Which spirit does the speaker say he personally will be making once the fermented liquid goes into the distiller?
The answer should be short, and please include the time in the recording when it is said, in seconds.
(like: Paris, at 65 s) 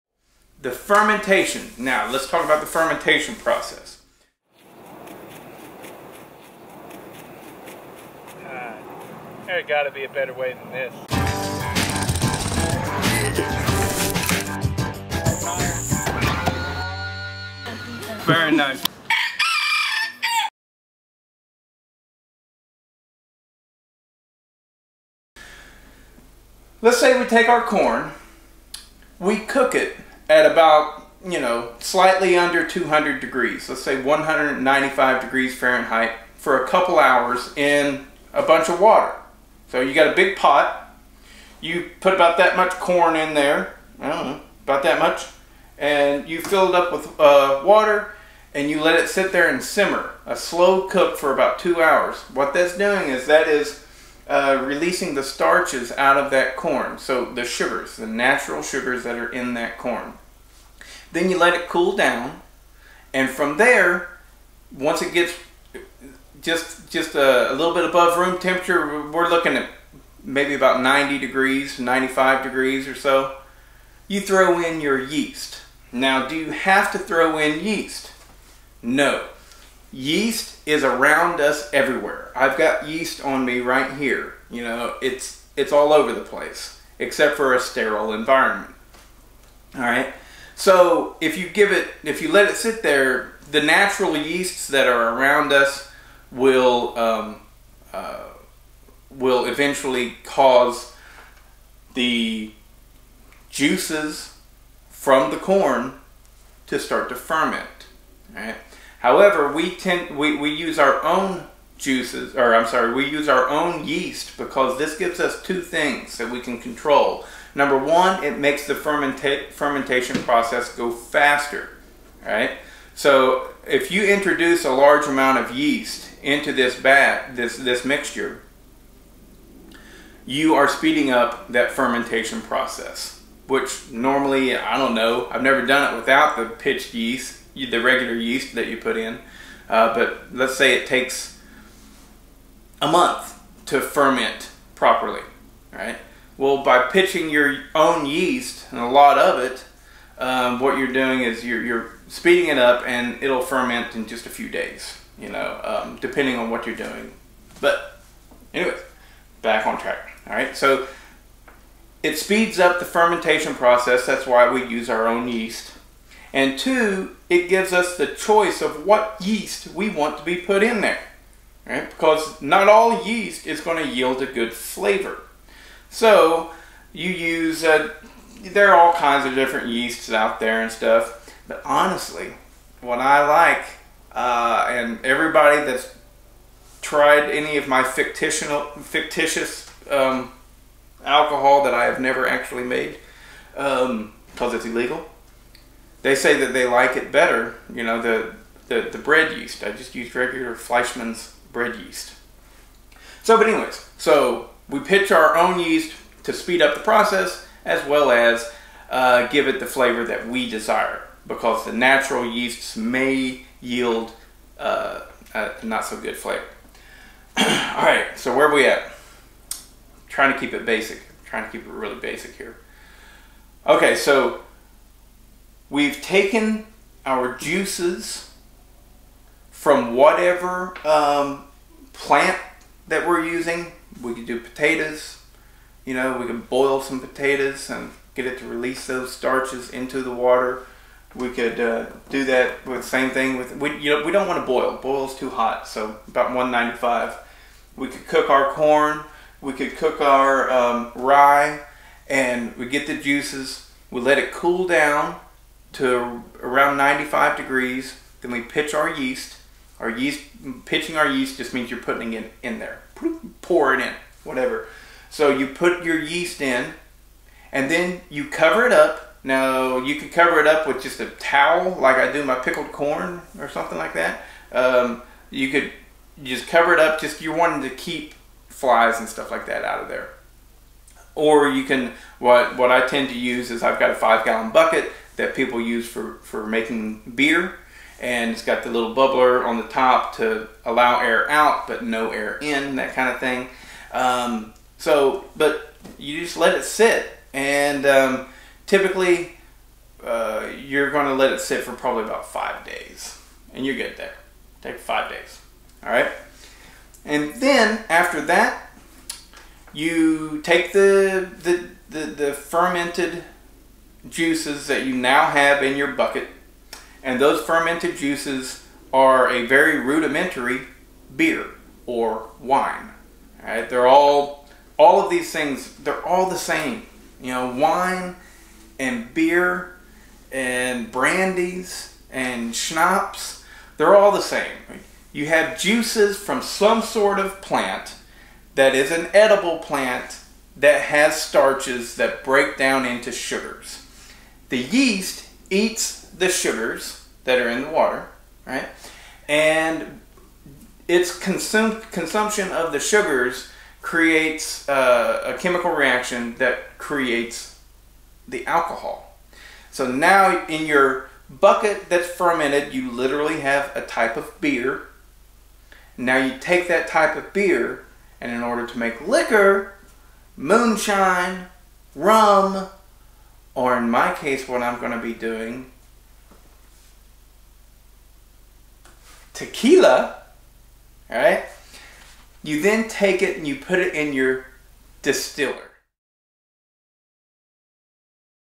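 Tequila, at 379 s.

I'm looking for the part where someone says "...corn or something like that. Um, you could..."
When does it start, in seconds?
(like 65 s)
272 s.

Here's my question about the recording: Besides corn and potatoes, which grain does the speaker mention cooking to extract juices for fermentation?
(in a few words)
Rye.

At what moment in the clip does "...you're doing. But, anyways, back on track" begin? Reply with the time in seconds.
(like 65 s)
156 s.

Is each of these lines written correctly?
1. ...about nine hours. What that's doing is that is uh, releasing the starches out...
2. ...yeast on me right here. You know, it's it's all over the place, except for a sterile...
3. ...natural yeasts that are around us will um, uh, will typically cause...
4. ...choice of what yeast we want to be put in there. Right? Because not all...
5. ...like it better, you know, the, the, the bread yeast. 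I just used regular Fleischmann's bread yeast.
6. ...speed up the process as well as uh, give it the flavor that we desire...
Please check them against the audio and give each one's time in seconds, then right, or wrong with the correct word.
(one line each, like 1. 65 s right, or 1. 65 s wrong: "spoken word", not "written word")
1. 51 s wrong: "two", not "nine"
2. 82 s right
3. 93 s wrong: "eventually", not "typically"
4. 168 s right
5. 196 s right
6. 206 s right.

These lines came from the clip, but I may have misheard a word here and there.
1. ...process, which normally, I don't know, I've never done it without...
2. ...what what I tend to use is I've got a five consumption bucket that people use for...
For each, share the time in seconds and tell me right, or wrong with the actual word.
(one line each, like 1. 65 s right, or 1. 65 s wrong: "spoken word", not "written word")
1. 132 s right
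2. 282 s wrong: "gallon", not "consumption".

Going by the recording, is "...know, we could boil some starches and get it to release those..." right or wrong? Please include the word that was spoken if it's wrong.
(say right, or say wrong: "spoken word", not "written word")
wrong: "potatoes", not "starches".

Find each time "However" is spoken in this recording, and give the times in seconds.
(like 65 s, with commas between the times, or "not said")
108 s.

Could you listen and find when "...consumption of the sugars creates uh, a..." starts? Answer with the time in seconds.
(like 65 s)
351 s.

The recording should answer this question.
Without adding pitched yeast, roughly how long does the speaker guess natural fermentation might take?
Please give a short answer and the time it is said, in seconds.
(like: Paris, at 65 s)
A month, at 142 s.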